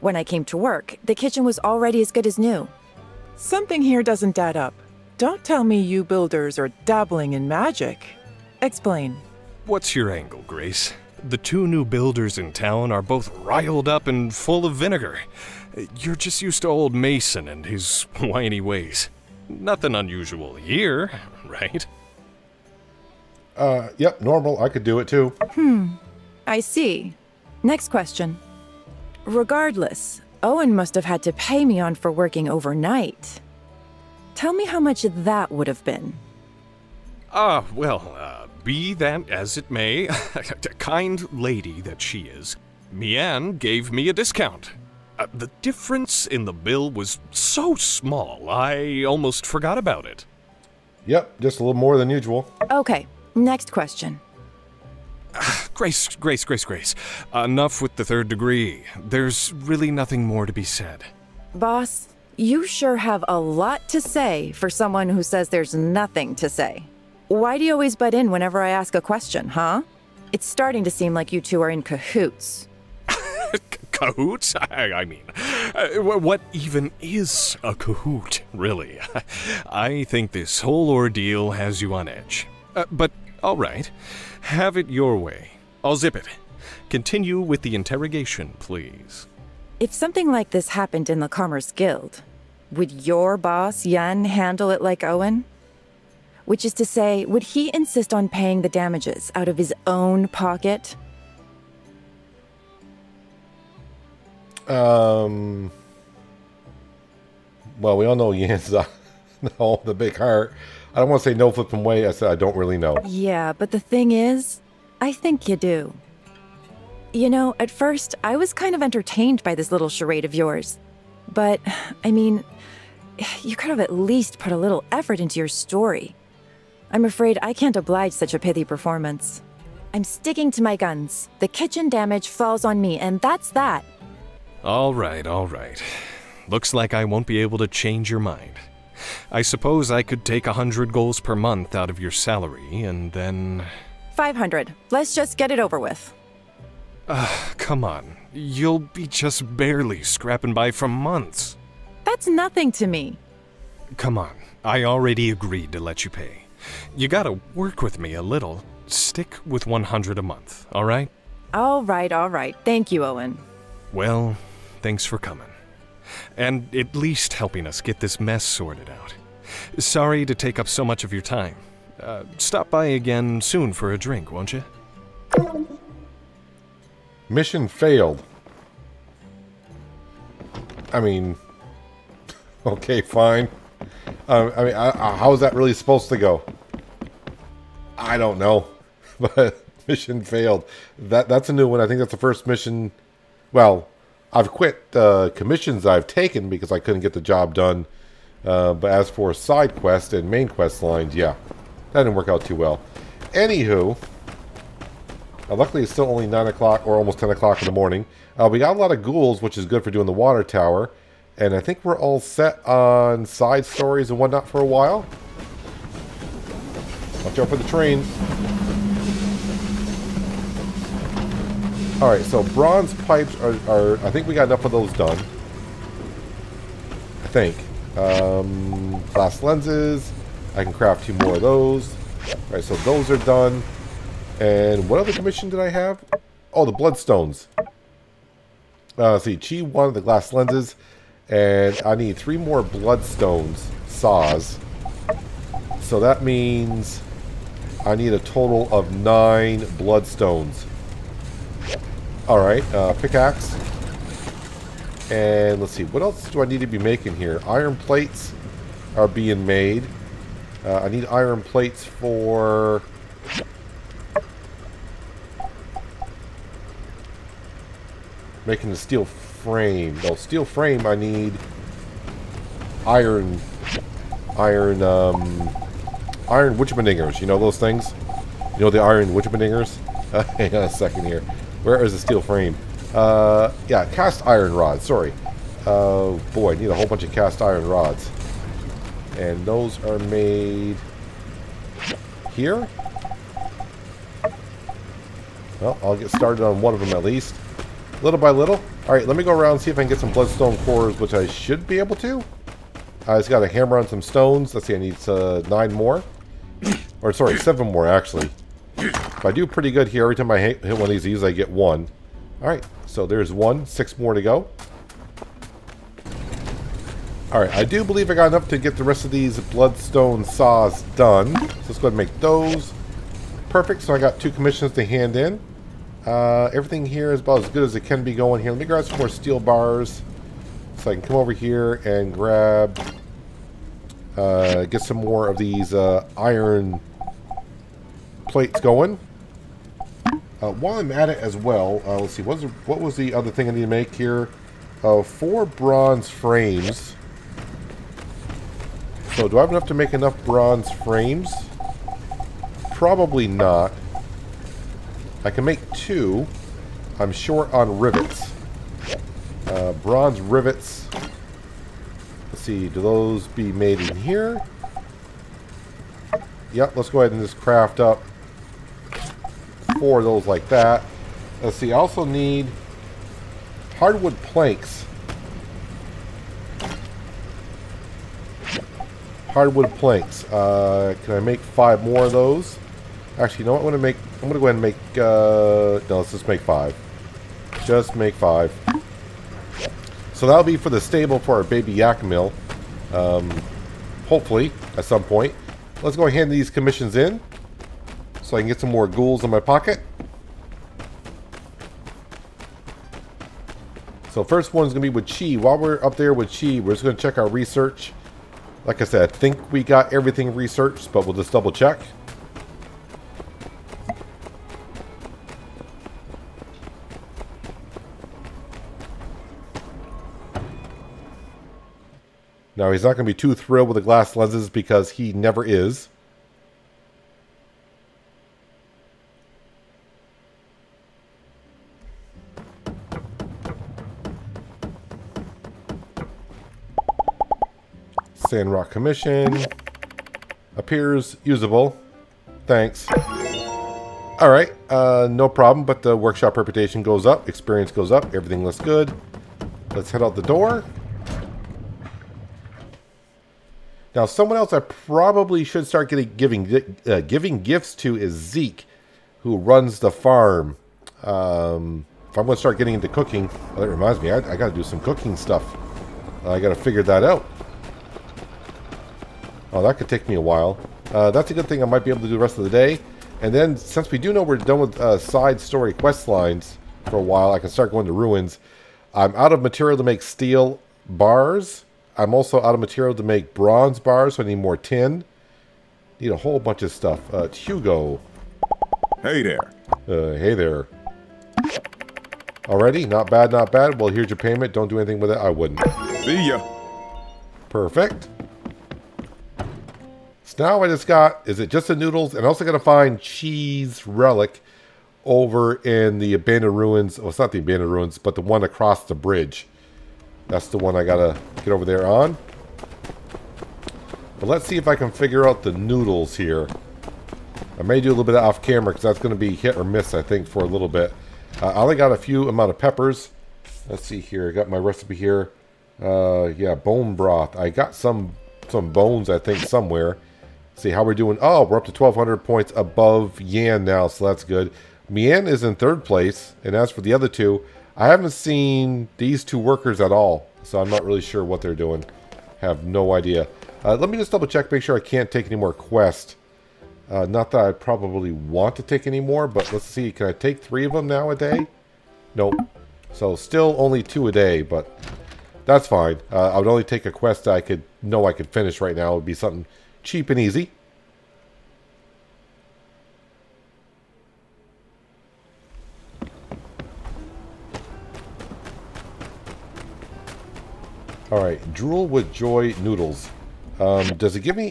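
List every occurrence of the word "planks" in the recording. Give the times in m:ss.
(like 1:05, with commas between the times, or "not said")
6:14, 6:19.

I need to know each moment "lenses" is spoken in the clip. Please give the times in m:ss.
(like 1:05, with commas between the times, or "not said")
3:49, 4:00, 7:04.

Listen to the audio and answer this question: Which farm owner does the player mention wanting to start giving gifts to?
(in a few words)
Zeke.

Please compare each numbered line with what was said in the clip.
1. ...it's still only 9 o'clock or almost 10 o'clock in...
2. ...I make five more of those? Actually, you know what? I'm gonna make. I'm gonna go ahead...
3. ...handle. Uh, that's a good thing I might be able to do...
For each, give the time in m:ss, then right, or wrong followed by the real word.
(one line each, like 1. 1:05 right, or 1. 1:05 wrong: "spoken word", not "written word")
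1. 3:25 right
2. 6:21 right
3. 7:50 wrong: "while", not "handle".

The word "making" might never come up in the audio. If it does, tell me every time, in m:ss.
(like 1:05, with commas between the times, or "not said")
4:16, 4:28.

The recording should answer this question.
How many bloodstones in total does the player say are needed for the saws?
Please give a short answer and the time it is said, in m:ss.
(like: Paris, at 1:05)
9, at 4:08.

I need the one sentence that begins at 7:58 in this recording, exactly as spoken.
I'm out of material to make steel bars.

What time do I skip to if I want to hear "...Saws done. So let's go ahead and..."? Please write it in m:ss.
5:20.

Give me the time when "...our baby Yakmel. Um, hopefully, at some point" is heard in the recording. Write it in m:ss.
6:31.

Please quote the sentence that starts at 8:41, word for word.
Uh, I only got a few amount of peppers.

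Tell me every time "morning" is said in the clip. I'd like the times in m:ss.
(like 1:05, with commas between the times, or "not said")
3:27.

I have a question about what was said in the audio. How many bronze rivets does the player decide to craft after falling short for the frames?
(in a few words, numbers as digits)
4.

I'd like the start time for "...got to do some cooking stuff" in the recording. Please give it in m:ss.
7:44.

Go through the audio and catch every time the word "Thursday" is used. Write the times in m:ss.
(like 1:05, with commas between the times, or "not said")
not said.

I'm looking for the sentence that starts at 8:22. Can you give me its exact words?
And also going to find cheese relic over in the abandoned ruins.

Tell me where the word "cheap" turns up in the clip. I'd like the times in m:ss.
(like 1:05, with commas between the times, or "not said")
9:19.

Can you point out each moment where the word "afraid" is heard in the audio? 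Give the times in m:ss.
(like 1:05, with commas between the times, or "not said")
2:07.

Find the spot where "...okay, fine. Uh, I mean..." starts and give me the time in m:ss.
3:02.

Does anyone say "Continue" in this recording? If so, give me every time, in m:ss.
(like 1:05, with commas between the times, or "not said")
1:26.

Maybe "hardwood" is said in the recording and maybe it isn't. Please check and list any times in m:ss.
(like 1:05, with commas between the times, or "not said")
6:13, 6:19.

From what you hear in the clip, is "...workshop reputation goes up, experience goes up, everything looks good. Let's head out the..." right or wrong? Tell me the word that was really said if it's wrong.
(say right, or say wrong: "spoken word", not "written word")
right.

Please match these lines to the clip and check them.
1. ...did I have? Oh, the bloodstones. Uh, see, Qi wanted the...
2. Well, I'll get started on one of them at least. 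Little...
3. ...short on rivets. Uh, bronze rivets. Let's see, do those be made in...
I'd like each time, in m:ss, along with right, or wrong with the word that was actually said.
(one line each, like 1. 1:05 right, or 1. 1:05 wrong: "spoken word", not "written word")
1. 3:55 right
2. 4:55 right
3. 5:57 right.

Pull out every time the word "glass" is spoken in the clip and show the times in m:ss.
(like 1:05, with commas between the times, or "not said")
3:49, 4:00, 7:03.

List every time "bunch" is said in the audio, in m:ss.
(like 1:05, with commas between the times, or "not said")
4:46, 8:06.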